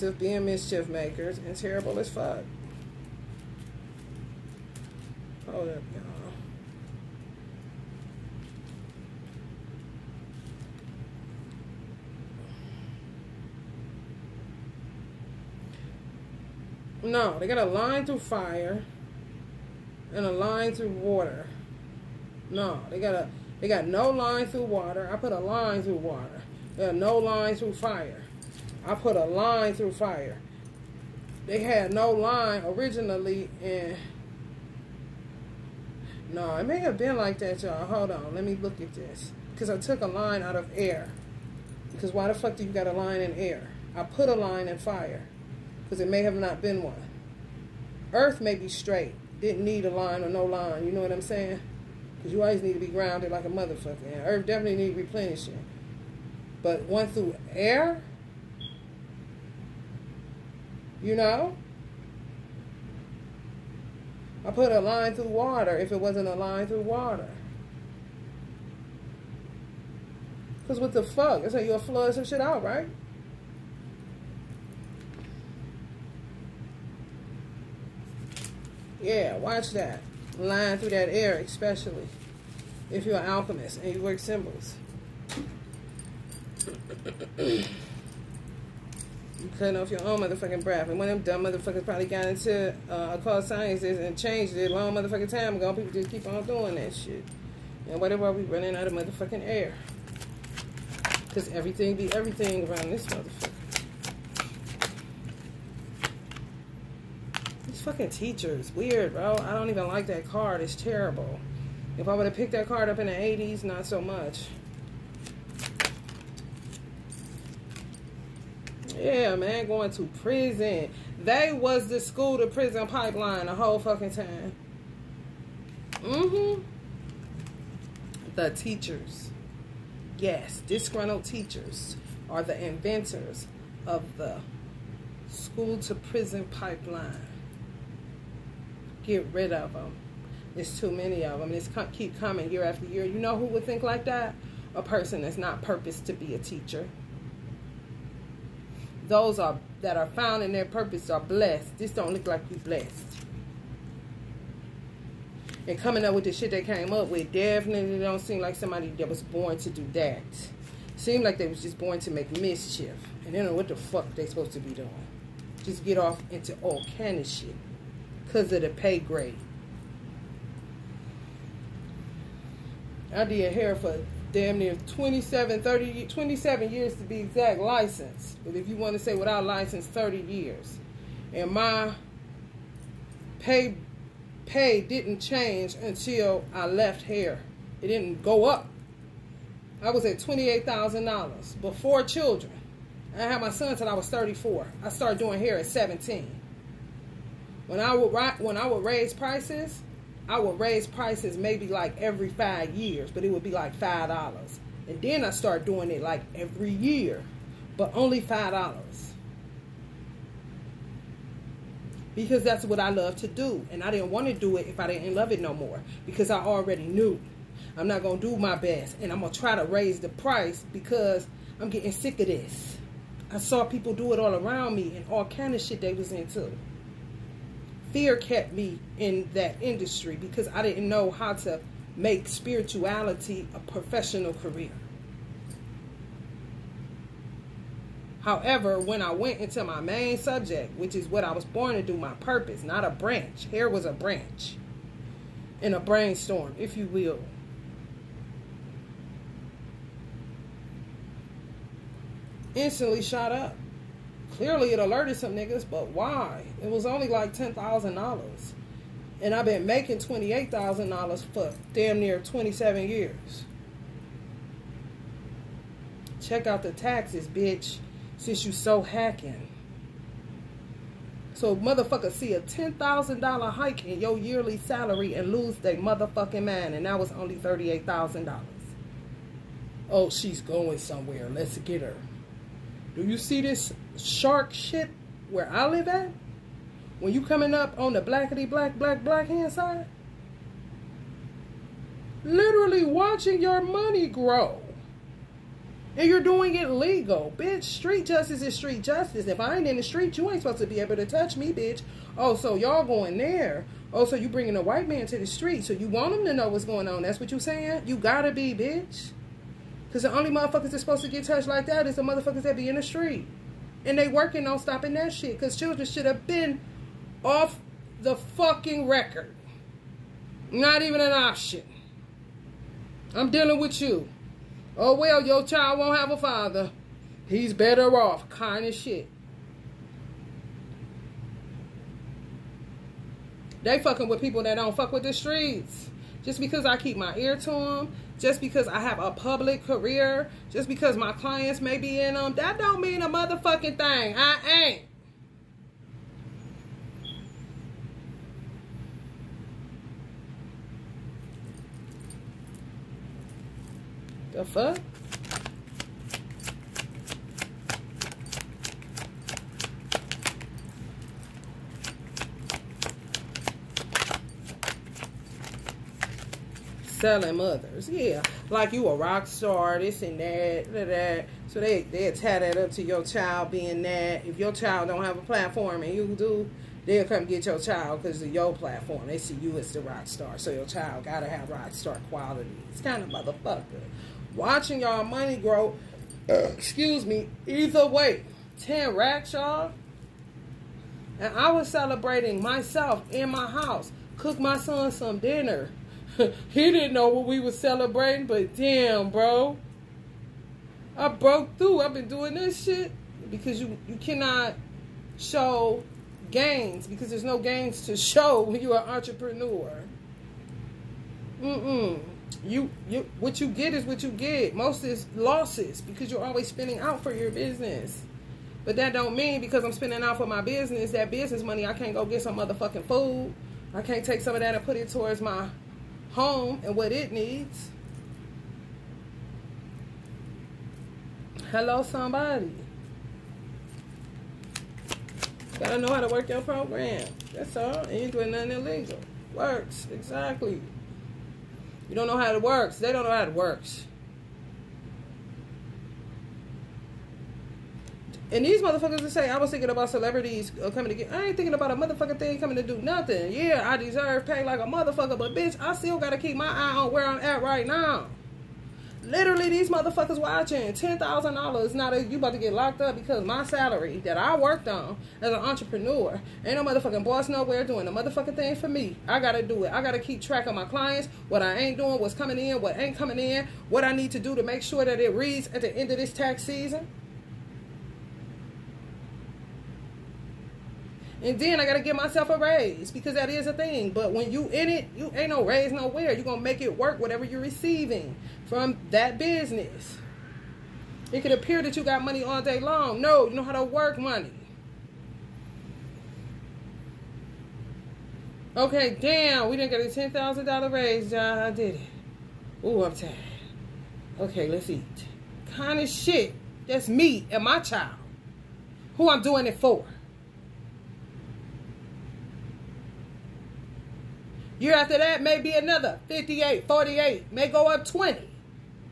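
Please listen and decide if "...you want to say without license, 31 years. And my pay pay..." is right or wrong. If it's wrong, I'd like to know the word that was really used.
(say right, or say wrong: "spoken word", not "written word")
wrong: "30", not "31".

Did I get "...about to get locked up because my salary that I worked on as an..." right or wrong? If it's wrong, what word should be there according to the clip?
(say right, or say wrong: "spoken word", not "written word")
right.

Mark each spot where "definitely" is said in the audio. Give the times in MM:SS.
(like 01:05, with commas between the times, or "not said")
00:54, 02:37.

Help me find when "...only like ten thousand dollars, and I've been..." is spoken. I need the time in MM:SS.
04:16.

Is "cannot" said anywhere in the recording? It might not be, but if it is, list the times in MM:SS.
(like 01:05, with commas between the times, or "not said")
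06:43.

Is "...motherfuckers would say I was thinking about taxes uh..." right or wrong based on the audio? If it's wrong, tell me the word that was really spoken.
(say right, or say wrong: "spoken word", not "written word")
wrong: "celebrities", not "taxes".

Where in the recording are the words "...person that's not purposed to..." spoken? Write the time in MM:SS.
02:24.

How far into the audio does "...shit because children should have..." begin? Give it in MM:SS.
05:15.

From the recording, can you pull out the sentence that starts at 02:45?
Just get off into all kind of shit because of the pay grade.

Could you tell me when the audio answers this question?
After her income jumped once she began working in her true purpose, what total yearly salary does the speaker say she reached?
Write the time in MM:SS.
04:37.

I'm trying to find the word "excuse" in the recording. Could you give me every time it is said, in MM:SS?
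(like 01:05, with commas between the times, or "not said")
06:26.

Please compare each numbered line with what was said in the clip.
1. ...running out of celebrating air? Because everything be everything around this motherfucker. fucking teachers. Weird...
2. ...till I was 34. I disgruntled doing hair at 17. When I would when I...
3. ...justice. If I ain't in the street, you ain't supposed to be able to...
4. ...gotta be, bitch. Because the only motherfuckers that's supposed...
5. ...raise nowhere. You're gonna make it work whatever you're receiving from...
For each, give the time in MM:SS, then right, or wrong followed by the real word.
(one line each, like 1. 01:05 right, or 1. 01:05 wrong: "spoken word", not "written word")
1. 01:38 wrong: "motherfucking", not "celebrating"
2. 03:13 wrong: "started", not "disgruntled"
3. 04:58 right
4. 05:07 right
5. 08:05 right.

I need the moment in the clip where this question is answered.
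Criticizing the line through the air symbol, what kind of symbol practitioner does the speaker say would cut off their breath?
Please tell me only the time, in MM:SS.
01:23.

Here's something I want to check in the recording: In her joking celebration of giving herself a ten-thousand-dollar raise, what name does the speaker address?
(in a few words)
John.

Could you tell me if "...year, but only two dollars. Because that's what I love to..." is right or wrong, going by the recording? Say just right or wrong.
wrong.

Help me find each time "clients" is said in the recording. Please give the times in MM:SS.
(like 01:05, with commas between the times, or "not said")
05:41, 07:50.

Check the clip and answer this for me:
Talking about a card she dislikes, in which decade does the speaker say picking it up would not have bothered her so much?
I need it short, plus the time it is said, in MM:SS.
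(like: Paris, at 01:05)
the 80s, at 01:53.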